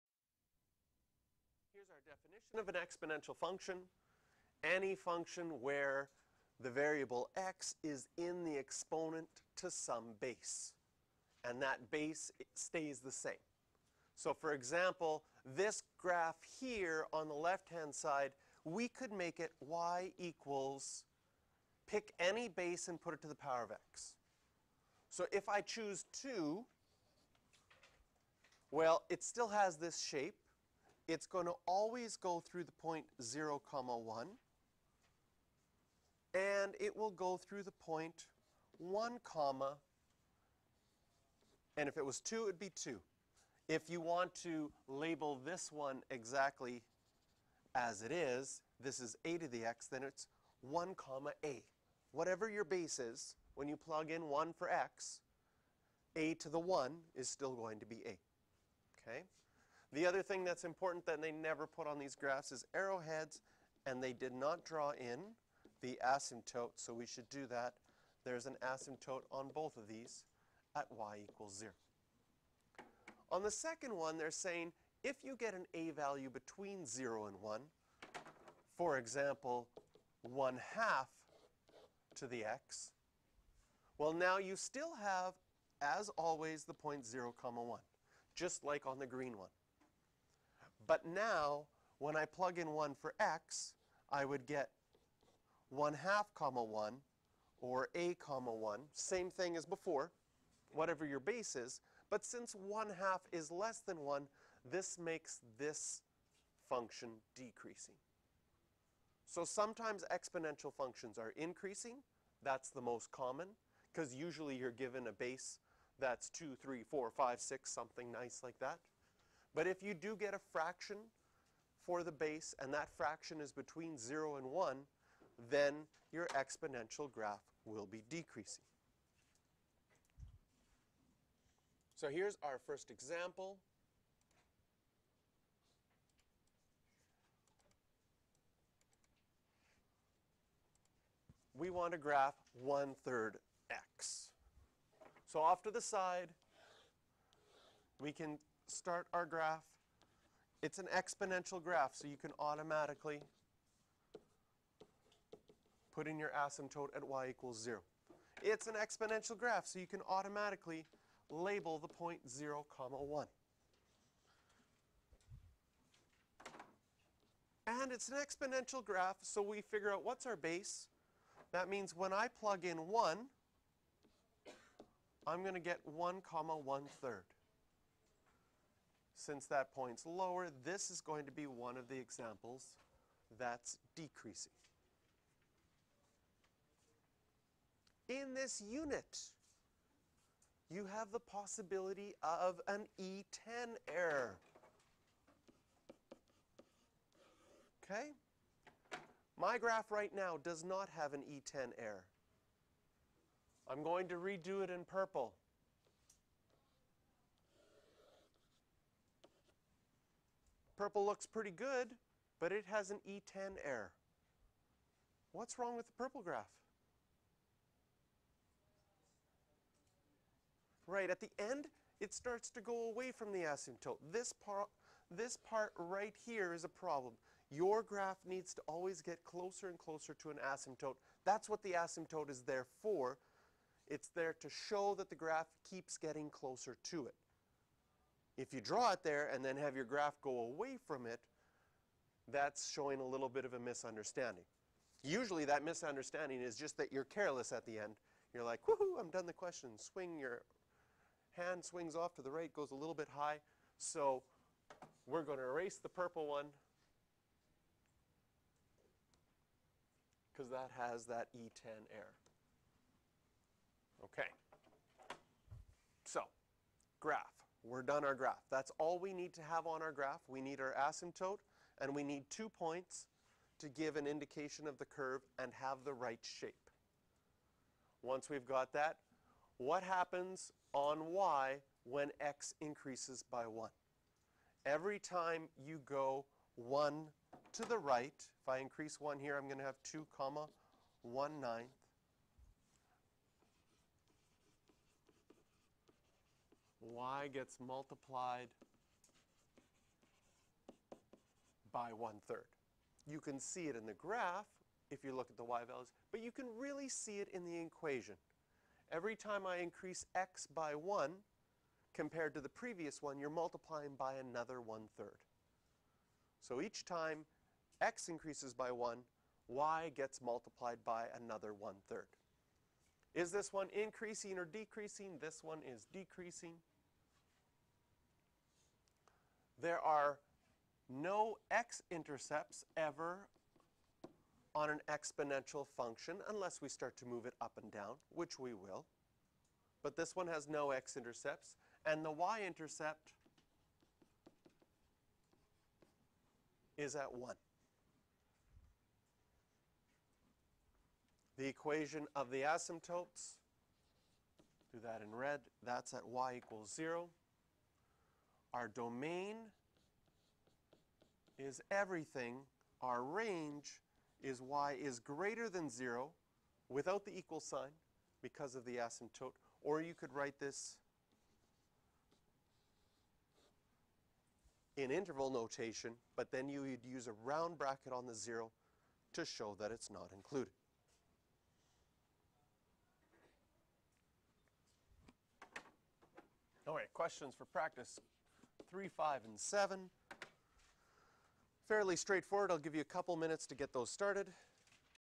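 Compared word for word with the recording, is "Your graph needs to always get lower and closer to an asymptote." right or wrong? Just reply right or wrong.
wrong.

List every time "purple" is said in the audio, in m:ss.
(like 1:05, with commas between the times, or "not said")
3:24, 3:30, 3:35, 4:15.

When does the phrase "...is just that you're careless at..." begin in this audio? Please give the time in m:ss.
4:06.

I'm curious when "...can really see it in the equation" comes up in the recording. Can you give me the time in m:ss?
5:06.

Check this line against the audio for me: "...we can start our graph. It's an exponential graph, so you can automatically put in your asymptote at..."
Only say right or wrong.
right.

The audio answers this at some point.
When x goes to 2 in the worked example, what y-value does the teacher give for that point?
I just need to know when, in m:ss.
4:51.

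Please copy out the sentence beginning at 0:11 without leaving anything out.
And that base stays the same.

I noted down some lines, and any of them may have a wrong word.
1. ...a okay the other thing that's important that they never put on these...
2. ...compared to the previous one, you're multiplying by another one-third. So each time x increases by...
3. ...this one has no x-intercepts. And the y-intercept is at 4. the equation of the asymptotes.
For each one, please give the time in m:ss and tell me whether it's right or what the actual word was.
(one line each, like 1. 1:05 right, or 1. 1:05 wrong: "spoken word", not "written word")
1. 0:58 right
2. 5:11 right
3. 5:39 wrong: "1", not "4".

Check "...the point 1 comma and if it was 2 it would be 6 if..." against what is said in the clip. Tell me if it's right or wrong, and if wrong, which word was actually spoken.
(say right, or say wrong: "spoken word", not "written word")
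wrong: "2", not "6".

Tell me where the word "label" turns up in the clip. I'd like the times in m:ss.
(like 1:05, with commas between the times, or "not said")
0:44, 2:41.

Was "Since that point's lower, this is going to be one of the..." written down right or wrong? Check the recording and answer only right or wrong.
right.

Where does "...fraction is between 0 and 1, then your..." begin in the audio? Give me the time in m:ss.
2:02.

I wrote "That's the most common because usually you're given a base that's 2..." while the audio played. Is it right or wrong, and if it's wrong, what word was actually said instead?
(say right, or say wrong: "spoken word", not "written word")
right.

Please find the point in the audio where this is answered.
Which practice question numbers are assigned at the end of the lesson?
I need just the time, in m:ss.
6:28.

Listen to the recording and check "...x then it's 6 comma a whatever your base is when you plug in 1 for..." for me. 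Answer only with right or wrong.
wrong.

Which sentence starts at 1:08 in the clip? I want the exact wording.
There's an asymptote on both of these at y equals 0.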